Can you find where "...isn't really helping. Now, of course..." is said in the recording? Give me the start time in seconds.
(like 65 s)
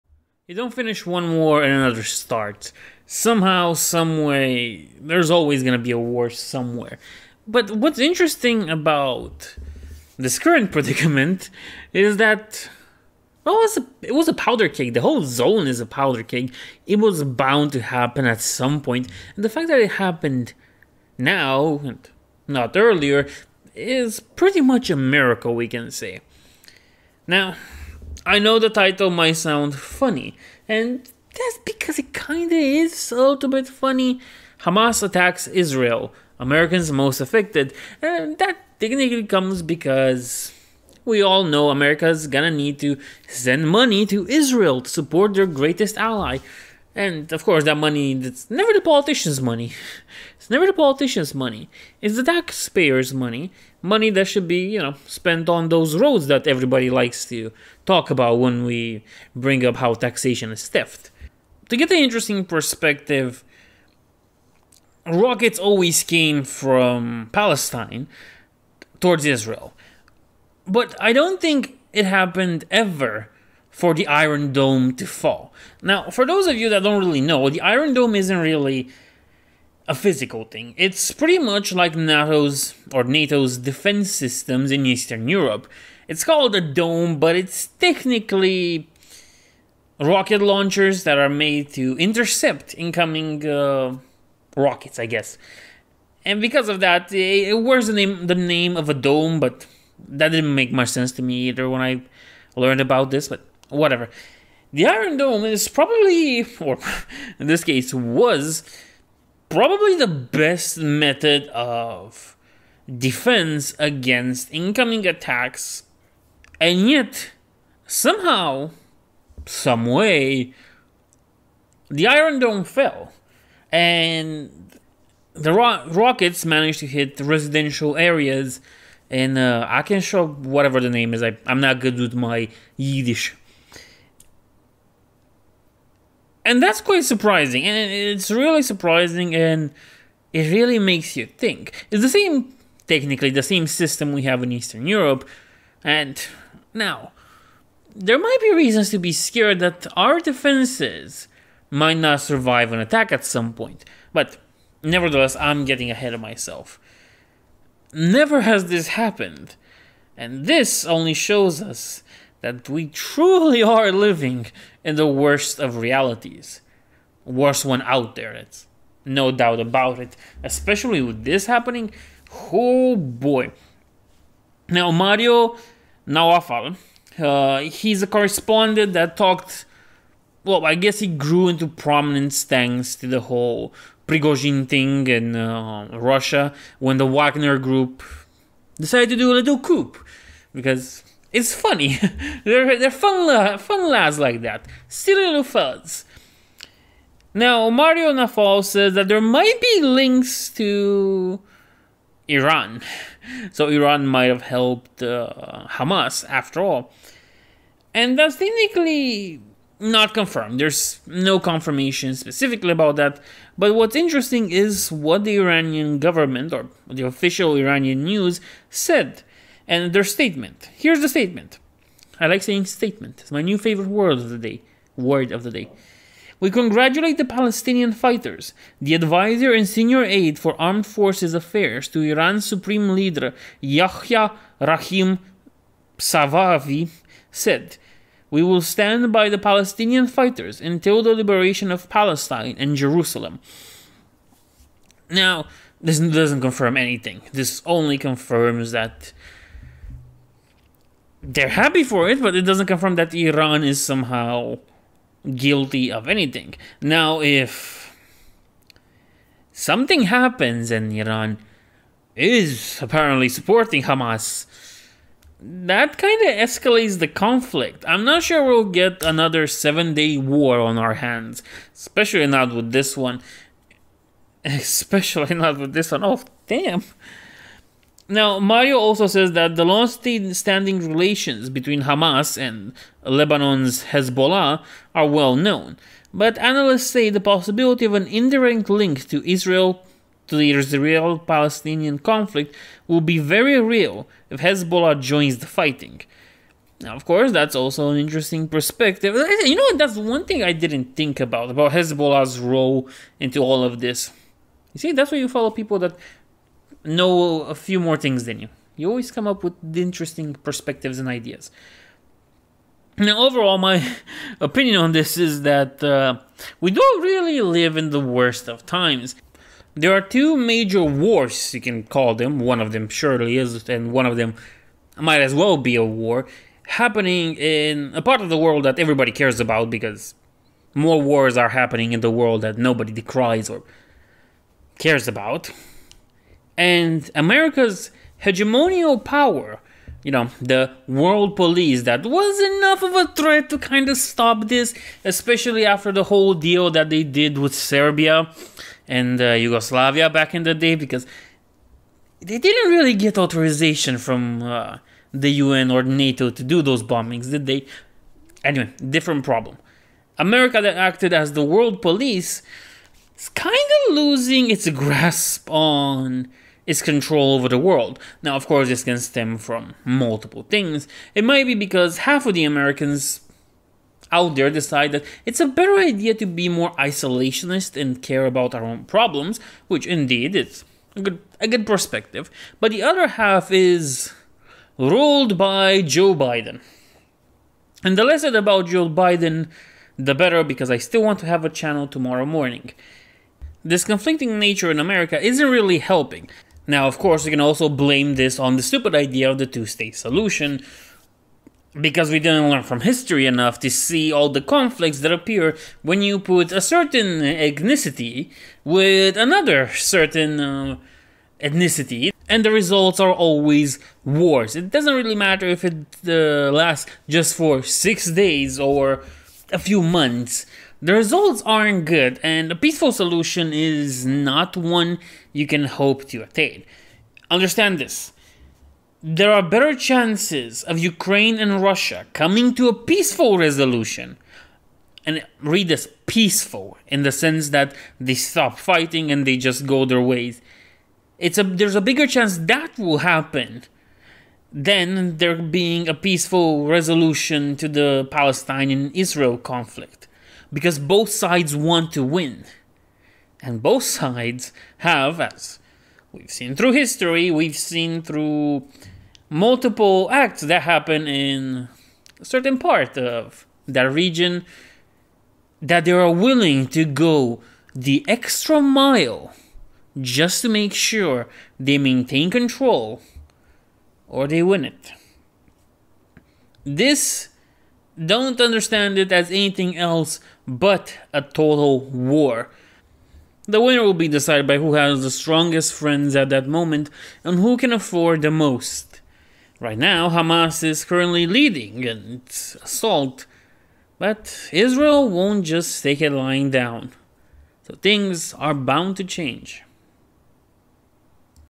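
395 s.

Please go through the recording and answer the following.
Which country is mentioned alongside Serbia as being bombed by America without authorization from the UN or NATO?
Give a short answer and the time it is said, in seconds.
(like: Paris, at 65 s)
Yugoslavia, at 349 s.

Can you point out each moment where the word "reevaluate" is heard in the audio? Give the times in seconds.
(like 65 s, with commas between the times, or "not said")
not said.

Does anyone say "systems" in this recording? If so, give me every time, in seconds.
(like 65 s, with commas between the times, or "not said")
84 s, 143 s.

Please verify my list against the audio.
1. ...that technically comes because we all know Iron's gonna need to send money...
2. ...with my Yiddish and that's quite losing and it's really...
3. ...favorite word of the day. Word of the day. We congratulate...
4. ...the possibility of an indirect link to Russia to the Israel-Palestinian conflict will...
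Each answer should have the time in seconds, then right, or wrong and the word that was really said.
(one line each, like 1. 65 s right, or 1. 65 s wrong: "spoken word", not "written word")
1. 38 s wrong: "America", not "Iron"
2. 131 s wrong: "surprising", not "losing"
3. 223 s right
4. 287 s wrong: "Israel", not "Russia".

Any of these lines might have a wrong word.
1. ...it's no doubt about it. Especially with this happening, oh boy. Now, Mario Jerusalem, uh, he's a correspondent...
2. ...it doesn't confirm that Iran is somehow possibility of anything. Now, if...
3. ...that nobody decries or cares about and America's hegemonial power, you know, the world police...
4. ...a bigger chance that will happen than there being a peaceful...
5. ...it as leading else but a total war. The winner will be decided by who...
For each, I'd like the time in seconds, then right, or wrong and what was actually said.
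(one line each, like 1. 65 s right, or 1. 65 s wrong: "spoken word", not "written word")
1. 168 s wrong: "Nawfal", not "Jerusalem"
2. 252 s wrong: "guilty", not "possibility"
3. 332 s right
4. 441 s right
5. 478 s wrong: "anything", not "leading".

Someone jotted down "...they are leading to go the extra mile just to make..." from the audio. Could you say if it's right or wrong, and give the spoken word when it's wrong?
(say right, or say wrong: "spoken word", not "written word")
wrong: "willing", not "leading".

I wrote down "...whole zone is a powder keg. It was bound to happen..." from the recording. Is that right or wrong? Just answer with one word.
right.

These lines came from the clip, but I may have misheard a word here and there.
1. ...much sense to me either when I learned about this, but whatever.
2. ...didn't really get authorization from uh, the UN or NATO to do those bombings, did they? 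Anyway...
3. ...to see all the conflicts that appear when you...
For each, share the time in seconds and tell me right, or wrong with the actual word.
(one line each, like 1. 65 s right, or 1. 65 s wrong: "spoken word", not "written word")
1. 100 s right
2. 352 s right
3. 403 s right.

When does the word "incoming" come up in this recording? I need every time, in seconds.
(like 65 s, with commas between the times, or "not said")
92 s, 114 s.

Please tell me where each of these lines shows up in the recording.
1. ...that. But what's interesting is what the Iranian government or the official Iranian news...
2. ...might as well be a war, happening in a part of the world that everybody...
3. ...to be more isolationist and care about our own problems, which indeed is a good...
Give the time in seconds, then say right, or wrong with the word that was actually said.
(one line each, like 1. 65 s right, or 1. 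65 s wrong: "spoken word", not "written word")
1. 212 s right
2. 324 s right
3. 376 s right.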